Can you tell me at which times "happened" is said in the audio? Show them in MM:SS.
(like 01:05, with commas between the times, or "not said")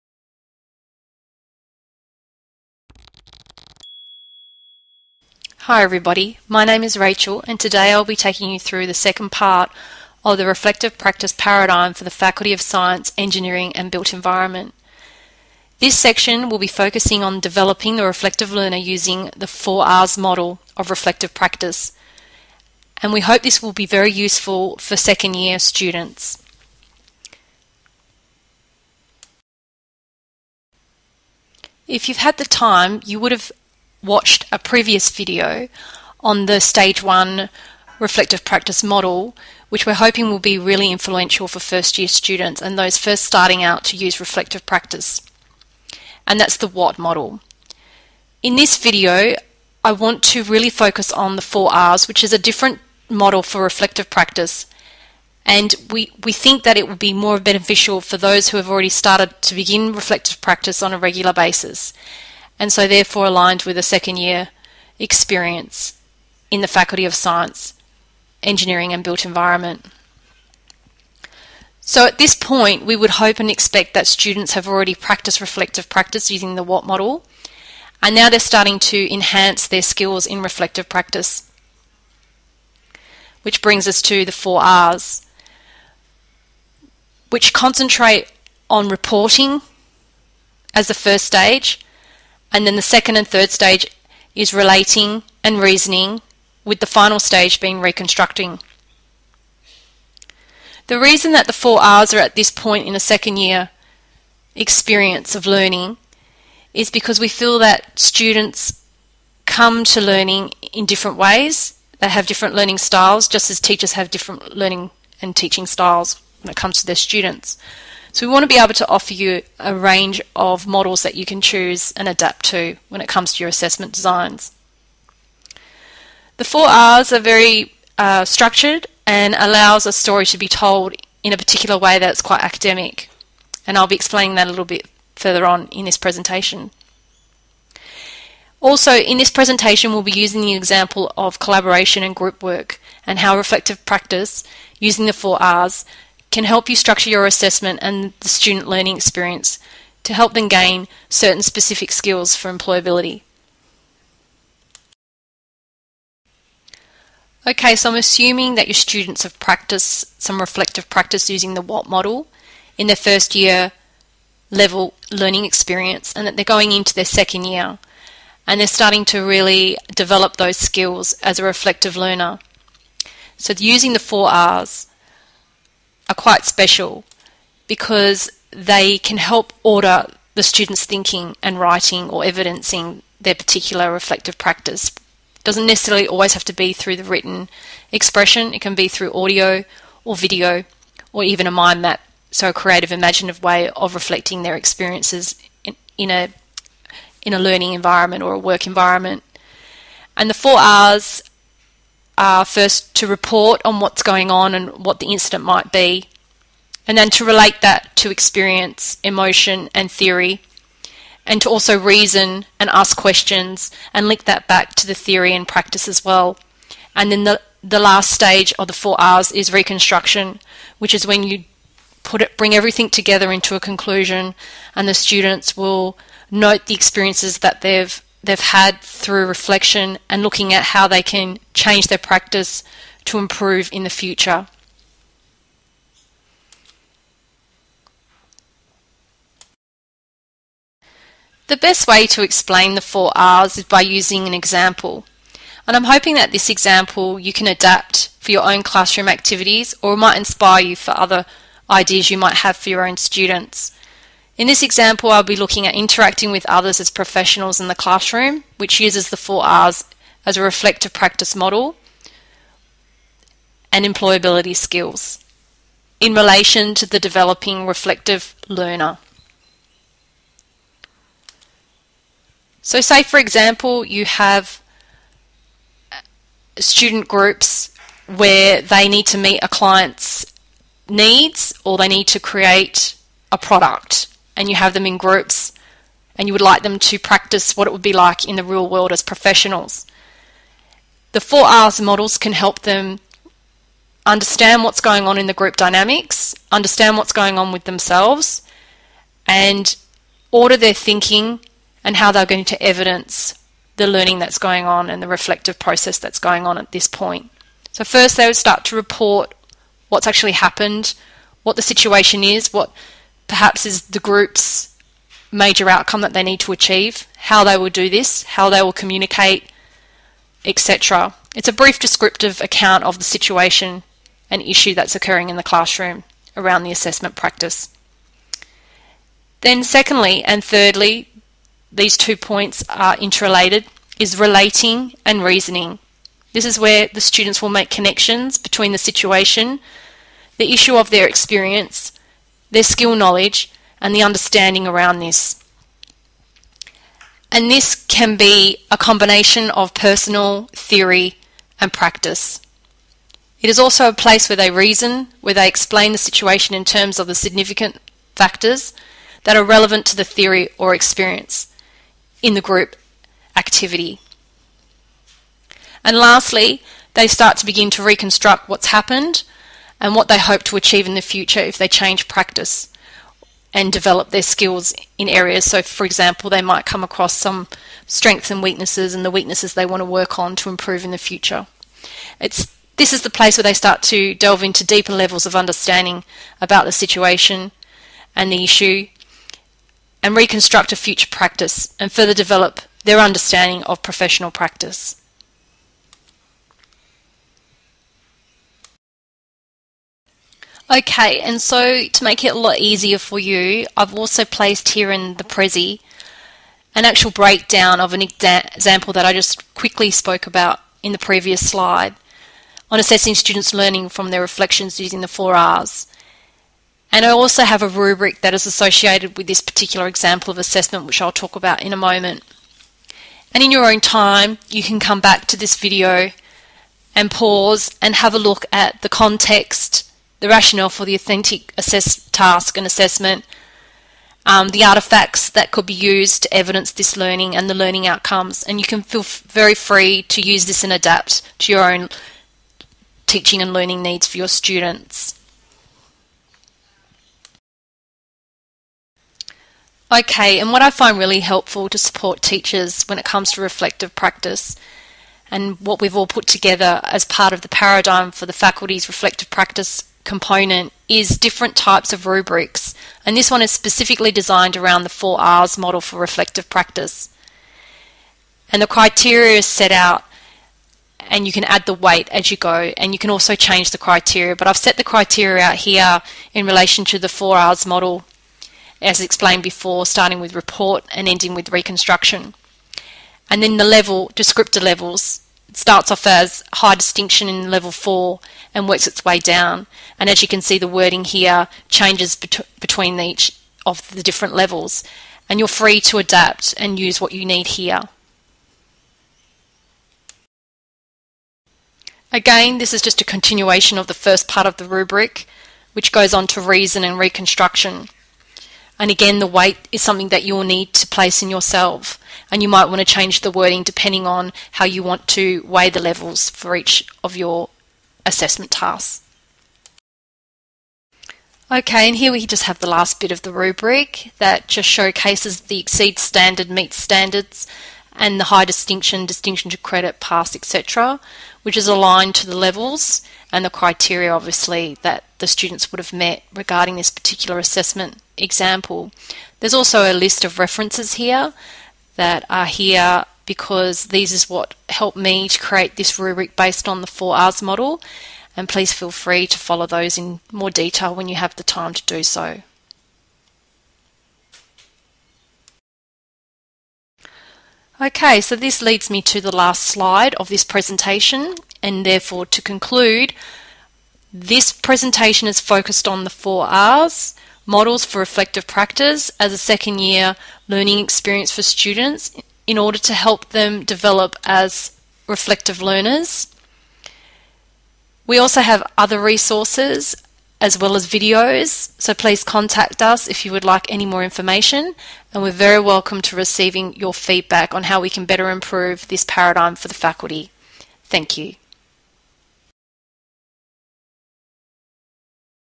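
05:10, 06:08.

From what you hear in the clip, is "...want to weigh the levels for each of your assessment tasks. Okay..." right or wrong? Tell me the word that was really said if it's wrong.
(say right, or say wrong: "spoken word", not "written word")
right.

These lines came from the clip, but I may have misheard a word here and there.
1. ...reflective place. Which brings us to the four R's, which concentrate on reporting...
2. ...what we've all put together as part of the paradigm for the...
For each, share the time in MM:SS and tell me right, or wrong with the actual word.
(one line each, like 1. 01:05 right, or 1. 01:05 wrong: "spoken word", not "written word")
1. 01:20 wrong: "practice", not "place"
2. 07:35 right.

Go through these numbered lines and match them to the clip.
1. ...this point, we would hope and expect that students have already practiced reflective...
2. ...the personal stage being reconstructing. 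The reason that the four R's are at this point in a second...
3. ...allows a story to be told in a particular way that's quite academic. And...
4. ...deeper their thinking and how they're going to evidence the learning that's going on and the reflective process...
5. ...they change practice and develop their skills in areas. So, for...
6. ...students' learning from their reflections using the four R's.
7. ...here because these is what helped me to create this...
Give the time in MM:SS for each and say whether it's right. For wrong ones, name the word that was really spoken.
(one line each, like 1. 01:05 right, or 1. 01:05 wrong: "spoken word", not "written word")
1. 01:12 right
2. 01:36 wrong: "final", not "personal"
3. 02:09 right
4. 05:00 wrong: "order", not "deeper"
5. 06:11 right
6. 06:53 right
7. 09:02 right.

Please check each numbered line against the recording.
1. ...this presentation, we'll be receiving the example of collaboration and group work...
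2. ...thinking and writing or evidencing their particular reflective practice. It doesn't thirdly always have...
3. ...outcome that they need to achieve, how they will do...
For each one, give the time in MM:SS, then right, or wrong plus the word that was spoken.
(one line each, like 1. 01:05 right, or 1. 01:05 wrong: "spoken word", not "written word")
1. 02:19 wrong: "using", not "receiving"
2. 03:00 wrong: "necessarily", not "thirdly"
3. 05:15 right.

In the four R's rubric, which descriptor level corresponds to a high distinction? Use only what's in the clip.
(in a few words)
level 4.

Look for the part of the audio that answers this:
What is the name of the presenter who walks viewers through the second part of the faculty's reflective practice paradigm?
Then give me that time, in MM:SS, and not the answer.
00:06.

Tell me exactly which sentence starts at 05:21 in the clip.
It's a brief descriptive account of the situation and issue that's occurring in the classroom around the assessment practice.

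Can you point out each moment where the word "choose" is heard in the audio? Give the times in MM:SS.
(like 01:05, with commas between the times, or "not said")
02:01.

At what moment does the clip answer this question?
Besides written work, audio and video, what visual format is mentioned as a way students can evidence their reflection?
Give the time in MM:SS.
03:11.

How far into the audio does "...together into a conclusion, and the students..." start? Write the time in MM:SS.
03:42.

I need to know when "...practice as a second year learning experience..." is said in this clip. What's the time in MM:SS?
09:28.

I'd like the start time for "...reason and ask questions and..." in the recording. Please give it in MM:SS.
03:31.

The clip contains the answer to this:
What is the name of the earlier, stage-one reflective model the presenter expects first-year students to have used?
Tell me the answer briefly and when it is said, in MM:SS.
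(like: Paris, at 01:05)
the what model, at 00:46.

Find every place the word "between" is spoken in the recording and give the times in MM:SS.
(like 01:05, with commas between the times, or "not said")
05:38, 08:12.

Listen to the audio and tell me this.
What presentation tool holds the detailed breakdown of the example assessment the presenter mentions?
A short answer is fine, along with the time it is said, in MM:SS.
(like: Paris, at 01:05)
Prezi, at 06:45.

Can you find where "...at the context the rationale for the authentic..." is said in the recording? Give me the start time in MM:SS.
07:08.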